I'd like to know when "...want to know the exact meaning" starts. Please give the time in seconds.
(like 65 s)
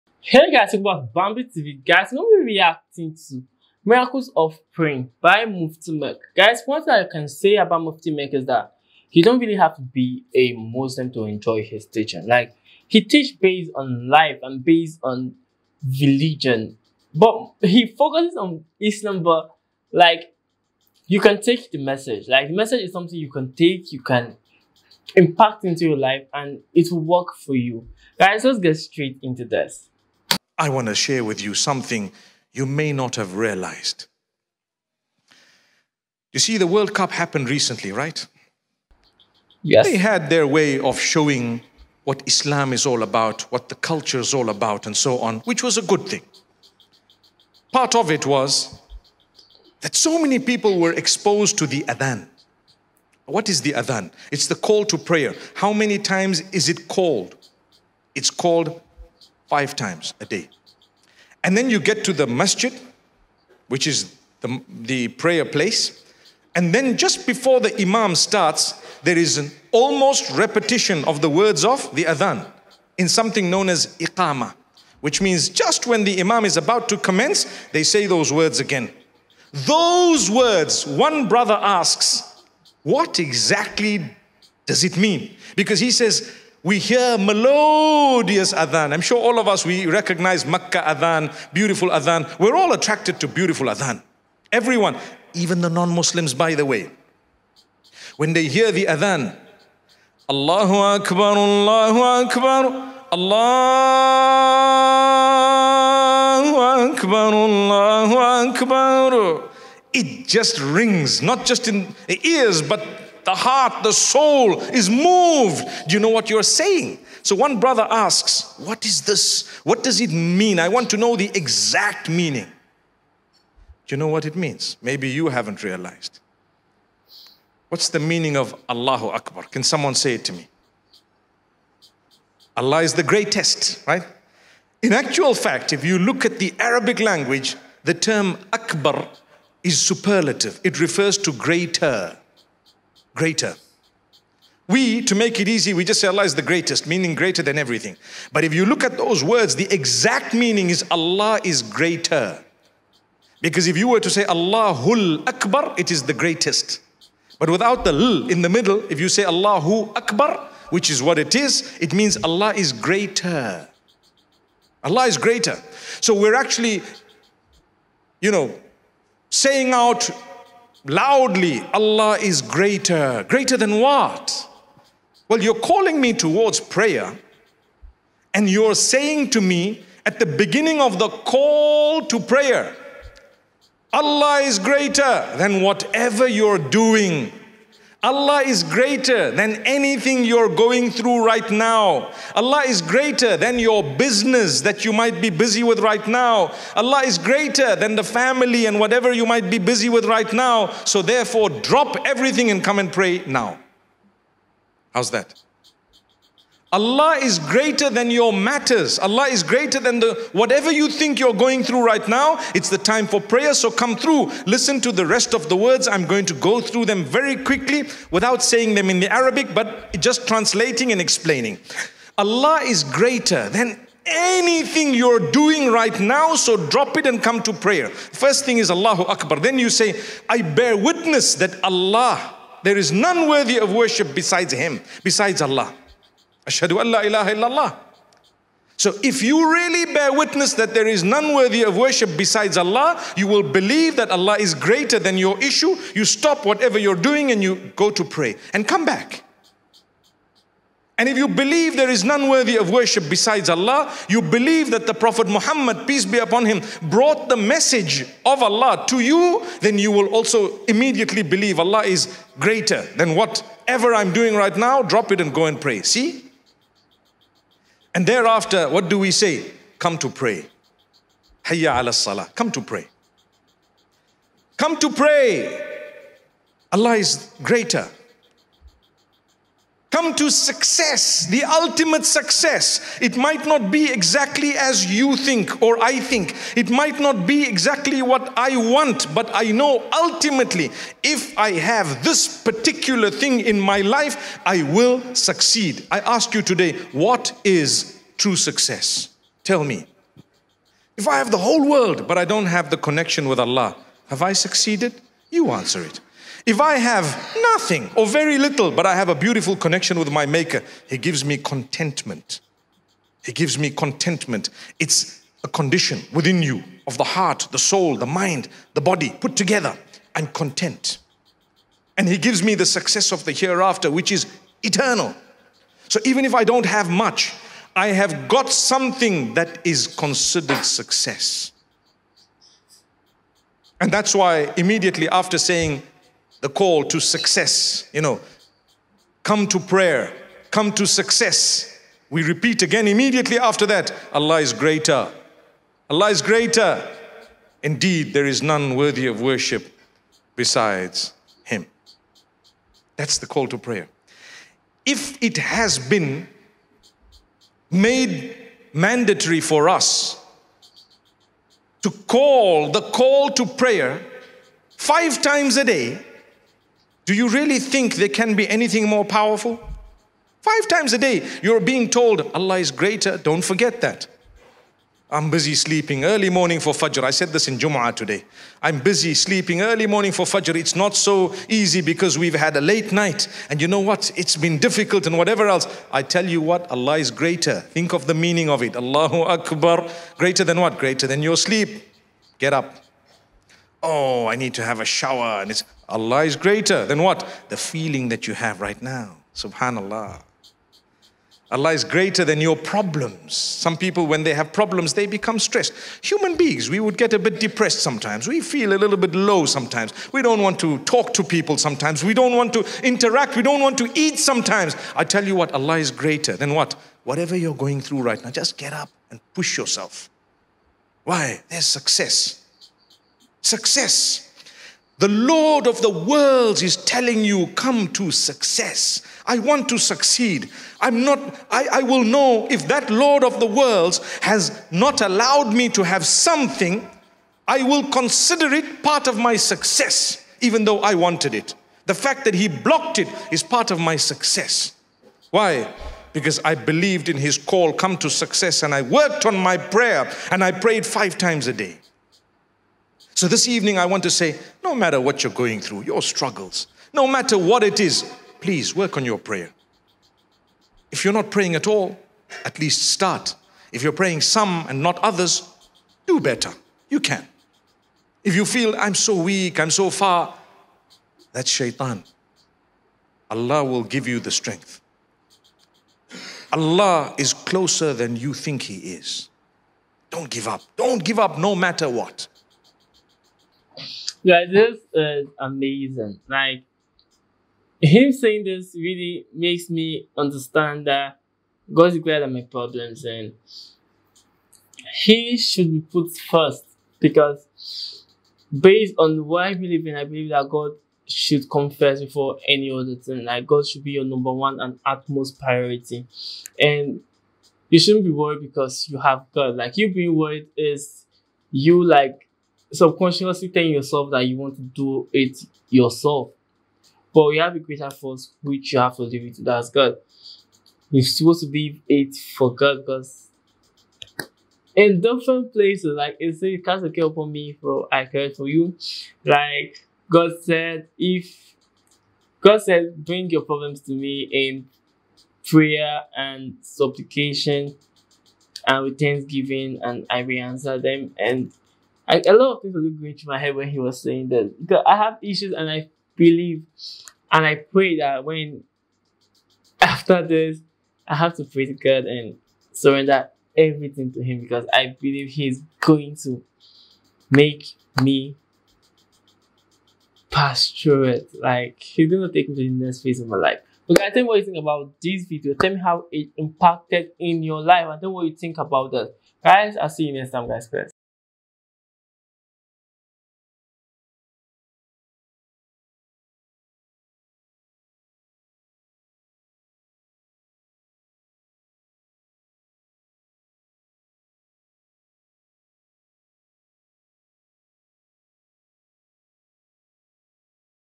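120 s.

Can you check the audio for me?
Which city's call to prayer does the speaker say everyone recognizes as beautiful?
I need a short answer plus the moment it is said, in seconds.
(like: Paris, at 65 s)
Makkah, at 90 s.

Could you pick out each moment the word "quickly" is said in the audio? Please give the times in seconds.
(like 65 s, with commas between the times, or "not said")
217 s.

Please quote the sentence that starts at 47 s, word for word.
Part of it was that so many people were exposed to the adhan.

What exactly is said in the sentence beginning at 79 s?
Those words, one brother asks, what exactly does it mean?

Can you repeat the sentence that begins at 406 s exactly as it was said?
Human beings, we would get a bit depressed sometimes.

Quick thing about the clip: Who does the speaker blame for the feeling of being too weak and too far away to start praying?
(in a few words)
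shaitan.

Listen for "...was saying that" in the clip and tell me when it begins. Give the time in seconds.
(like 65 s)
543 s.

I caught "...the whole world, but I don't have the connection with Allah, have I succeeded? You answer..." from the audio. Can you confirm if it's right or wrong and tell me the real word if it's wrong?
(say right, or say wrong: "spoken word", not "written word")
right.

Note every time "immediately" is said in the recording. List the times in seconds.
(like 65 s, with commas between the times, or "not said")
260 s, 334 s, 342 s.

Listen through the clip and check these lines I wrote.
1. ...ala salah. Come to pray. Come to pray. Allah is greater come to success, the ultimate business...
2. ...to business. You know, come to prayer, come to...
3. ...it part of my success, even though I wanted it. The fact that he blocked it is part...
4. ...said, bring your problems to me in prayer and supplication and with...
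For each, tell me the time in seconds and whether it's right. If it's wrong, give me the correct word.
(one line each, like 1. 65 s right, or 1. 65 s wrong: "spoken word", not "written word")
1. 271 s wrong: "success", not "business"
2. 336 s wrong: "success", not "business"
3. 438 s right
4. 532 s right.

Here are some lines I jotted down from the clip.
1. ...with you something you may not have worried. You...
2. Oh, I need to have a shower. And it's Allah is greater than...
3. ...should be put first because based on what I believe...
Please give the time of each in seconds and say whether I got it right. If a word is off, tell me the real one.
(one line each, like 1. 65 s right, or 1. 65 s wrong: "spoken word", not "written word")
1. 31 s wrong: "realized", not "worried"
2. 393 s right
3. 495 s right.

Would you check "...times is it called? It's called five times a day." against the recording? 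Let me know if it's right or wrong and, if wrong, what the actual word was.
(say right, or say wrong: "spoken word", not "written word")
right.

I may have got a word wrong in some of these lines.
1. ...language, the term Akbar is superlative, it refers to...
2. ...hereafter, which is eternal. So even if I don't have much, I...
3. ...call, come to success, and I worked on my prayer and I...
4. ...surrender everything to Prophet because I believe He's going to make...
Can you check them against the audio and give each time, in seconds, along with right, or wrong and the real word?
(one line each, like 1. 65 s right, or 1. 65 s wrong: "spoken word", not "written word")
1. 136 s right
2. 323 s right
3. 447 s right
4. 552 s wrong: "Him", not "Prophet".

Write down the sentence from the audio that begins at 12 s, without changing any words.
Like, he teach based on life and based on religion.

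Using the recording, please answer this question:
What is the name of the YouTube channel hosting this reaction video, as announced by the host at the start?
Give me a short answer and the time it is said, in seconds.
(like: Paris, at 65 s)
Bambi TV, at 1 s.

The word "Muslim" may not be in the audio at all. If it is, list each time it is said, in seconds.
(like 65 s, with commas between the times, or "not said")
10 s, 95 s.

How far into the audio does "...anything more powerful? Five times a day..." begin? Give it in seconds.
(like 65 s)
368 s.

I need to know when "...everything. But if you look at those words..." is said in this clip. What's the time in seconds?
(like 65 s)
147 s.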